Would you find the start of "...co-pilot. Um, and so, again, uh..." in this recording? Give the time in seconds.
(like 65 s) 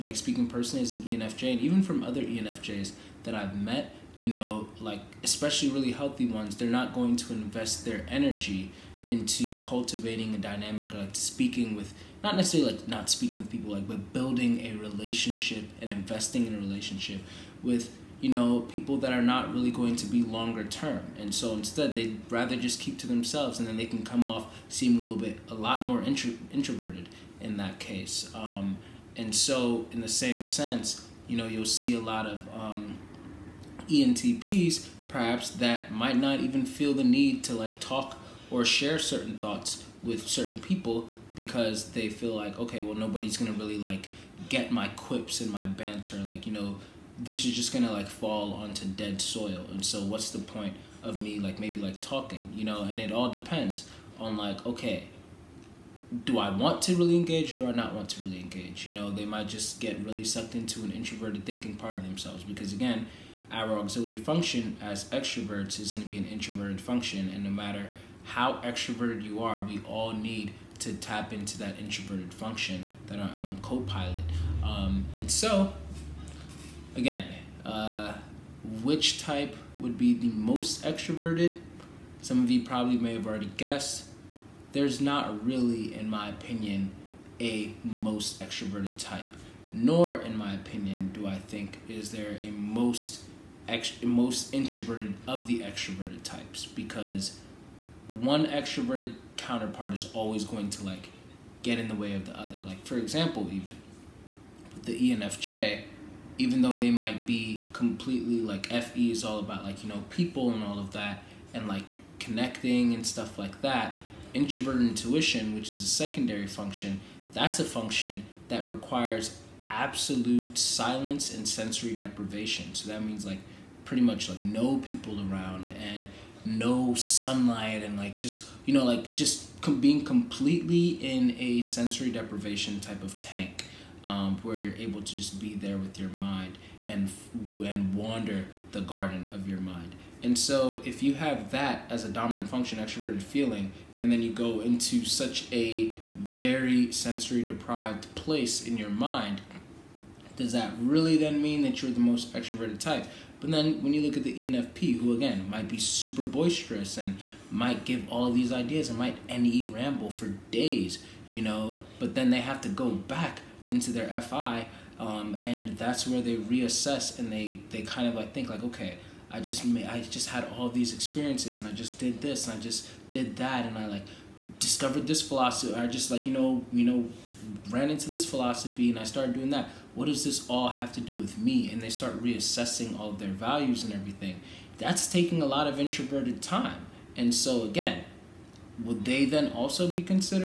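73 s.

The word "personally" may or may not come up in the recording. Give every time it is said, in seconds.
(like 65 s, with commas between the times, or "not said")
0 s.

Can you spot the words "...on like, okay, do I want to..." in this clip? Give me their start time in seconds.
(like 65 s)
54 s.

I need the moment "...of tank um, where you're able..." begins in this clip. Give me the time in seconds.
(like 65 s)
133 s.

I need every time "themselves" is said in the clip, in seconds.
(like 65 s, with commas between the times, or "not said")
23 s, 62 s.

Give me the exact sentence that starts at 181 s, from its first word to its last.
And they start reassessing all their values and everything.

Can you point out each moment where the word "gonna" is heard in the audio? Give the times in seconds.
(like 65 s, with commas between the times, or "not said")
43 s, 47 s.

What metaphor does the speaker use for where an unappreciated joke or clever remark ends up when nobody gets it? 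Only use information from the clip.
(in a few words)
dead soil.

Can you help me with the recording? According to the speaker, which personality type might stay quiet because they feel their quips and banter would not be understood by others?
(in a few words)
ENTPs.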